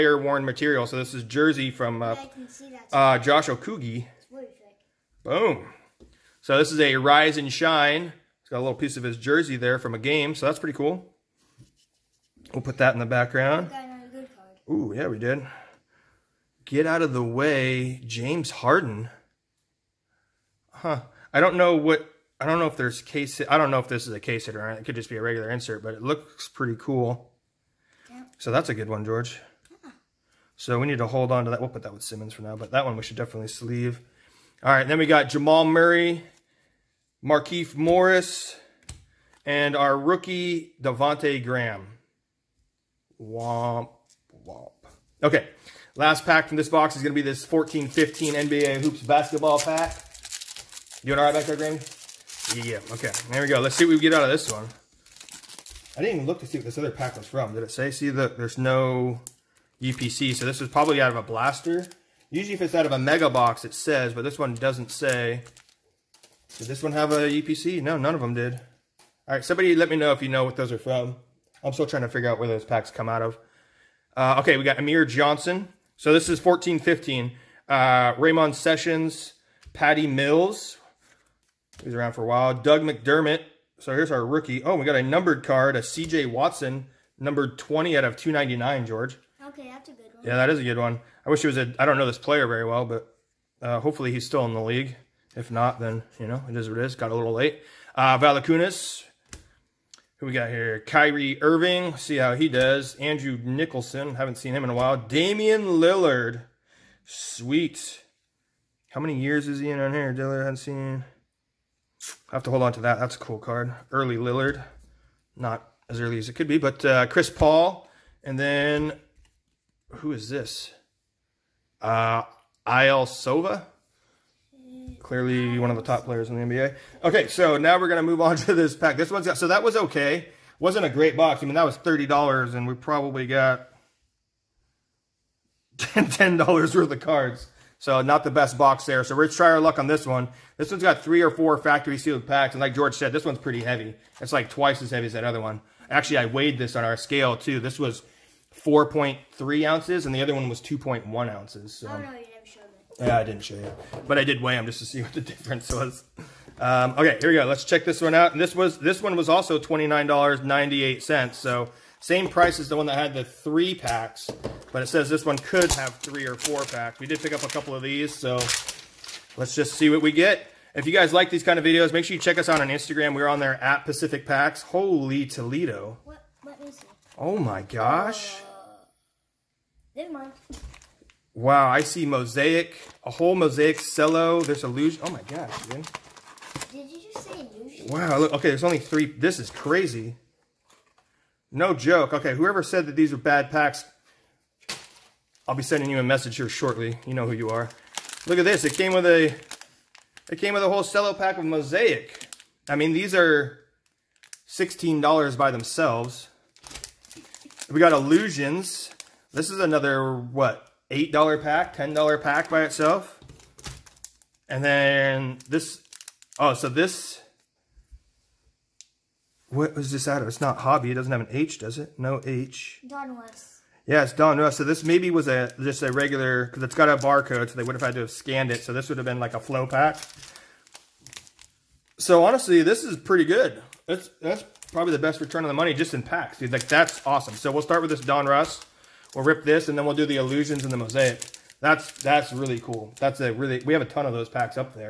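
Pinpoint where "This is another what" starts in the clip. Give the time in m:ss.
3:29.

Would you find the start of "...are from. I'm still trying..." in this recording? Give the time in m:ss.
1:10.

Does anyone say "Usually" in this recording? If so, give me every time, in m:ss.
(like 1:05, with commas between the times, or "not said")
1:02.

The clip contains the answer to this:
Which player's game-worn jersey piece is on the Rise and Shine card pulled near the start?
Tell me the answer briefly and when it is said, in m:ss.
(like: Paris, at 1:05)
Josh Okogie, at 0:03.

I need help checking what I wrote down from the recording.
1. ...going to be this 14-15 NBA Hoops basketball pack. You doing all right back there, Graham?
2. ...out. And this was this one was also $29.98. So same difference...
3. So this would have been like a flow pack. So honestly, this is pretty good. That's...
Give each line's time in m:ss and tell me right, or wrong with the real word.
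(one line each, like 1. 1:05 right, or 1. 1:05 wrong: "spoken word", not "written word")
1. 0:47 right
2. 2:38 wrong: "price", not "difference"
3. 3:48 right.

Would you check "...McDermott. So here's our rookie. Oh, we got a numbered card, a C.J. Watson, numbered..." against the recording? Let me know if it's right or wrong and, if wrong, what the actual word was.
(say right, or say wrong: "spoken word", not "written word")
right.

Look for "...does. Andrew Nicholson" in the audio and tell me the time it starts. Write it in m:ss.
1:42.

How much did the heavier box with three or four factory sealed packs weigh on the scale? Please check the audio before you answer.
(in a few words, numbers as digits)
4.3 ounces.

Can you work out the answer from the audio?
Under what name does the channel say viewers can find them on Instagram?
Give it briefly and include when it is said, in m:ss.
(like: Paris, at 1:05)
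Pacific Packs, at 2:53.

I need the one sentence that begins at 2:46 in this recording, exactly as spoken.
We did pick up a couple of these.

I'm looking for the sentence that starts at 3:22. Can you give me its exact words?
I mean, these are $16 by themselves.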